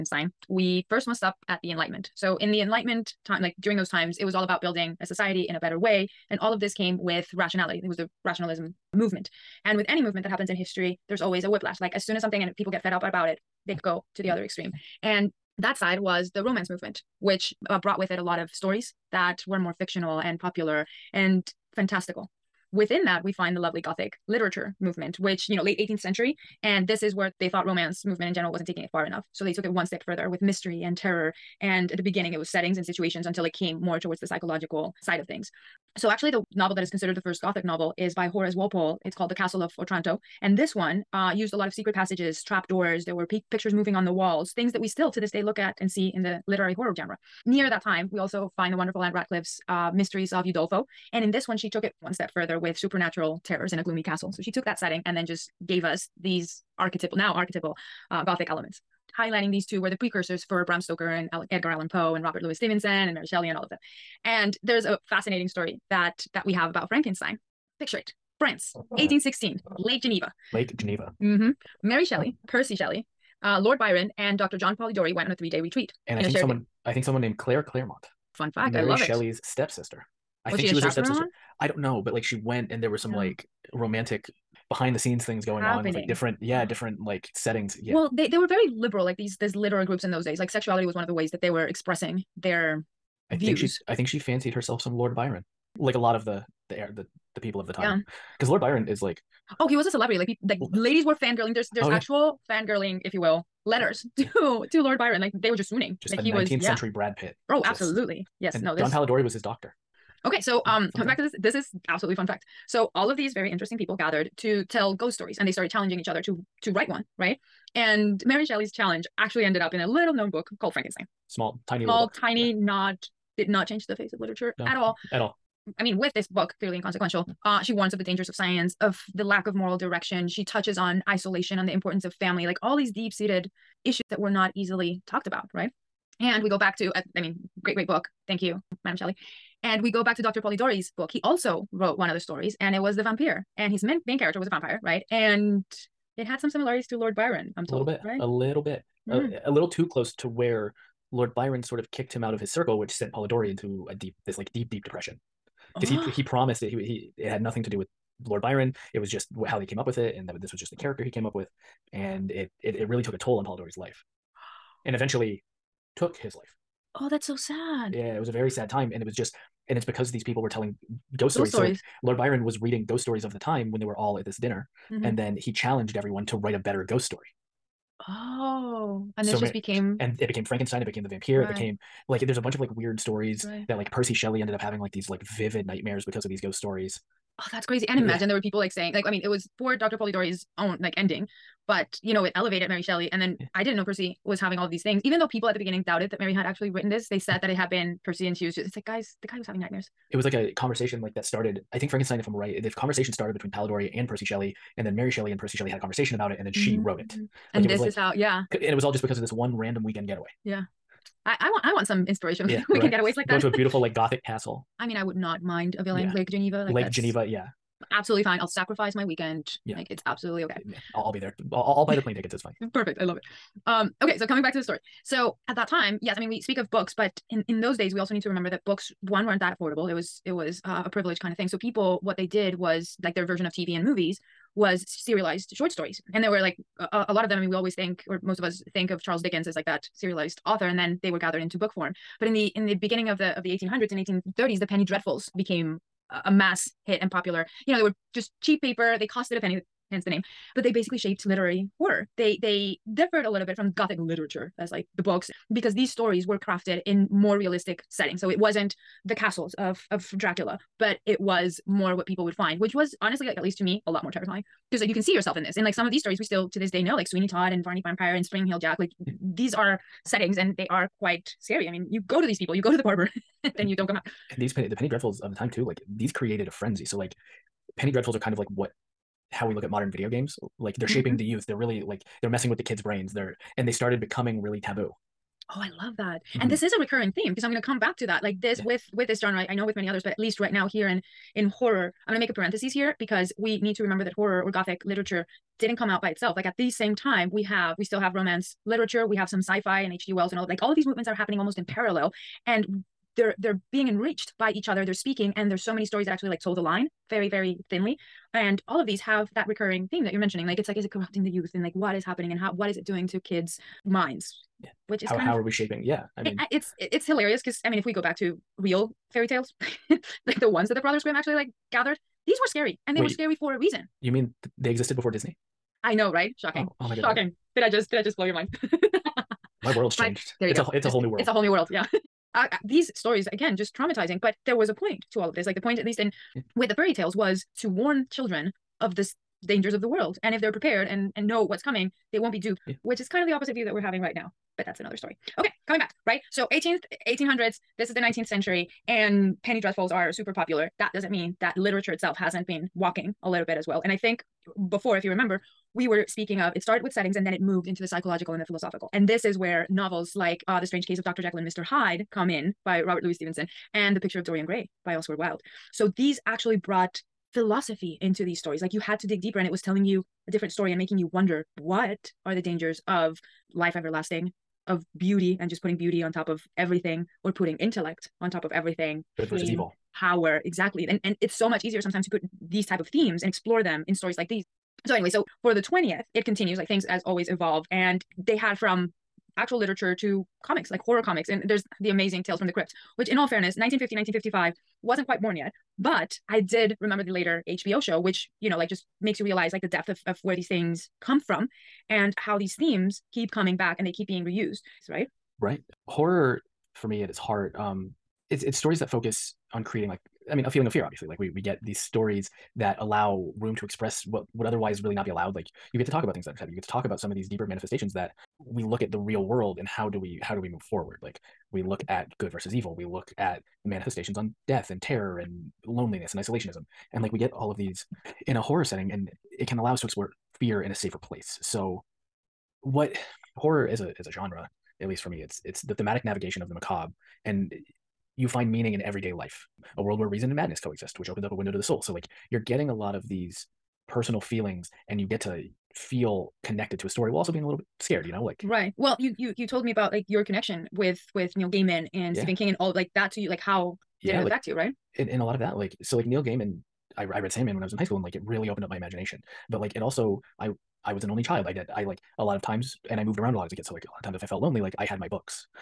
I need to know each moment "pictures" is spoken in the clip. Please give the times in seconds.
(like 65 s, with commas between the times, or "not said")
43 s, 67 s, 363 s.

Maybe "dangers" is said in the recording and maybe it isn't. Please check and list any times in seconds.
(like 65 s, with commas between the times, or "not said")
128 s, 339 s, 372 s.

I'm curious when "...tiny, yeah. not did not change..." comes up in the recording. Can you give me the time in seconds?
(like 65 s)
122 s.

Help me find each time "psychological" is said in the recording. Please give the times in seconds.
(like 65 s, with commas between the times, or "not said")
34 s, 357 s.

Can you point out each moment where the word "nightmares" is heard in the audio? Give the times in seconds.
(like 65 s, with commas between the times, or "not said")
185 s, 199 s.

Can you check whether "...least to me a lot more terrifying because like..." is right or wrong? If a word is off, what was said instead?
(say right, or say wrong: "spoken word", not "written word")
right.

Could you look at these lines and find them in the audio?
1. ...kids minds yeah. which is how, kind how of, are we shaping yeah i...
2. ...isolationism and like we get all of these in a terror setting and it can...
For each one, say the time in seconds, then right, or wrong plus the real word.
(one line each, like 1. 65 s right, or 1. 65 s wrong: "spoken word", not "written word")
1. 313 s right
2. 426 s wrong: "horror", not "terror".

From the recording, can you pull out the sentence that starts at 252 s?
They they differed a little bit from gothic literature as like the books because these stories were crafted in more realistic settings.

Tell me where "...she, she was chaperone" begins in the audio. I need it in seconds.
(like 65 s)
80 s.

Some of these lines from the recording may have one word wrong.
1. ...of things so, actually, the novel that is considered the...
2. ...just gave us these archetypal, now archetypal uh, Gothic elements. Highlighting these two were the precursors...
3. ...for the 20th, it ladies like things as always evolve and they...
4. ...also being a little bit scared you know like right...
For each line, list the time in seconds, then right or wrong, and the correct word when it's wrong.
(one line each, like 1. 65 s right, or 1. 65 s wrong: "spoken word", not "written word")
1. 35 s right
2. 55 s right
3. 385 s wrong: "continues", not "ladies"
4. 447 s right.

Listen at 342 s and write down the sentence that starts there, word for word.
which is kind of the opposite view that we're having right now.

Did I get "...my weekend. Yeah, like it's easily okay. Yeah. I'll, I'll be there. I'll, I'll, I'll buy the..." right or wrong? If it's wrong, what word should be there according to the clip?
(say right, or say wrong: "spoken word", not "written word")
wrong: "absolutely", not "easily".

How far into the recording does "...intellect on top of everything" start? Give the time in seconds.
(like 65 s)
377 s.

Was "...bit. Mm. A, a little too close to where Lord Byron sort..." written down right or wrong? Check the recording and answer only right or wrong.
right.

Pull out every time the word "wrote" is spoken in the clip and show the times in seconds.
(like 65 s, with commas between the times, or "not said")
141 s, 206 s.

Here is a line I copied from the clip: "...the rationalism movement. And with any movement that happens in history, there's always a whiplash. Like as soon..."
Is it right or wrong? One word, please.
right.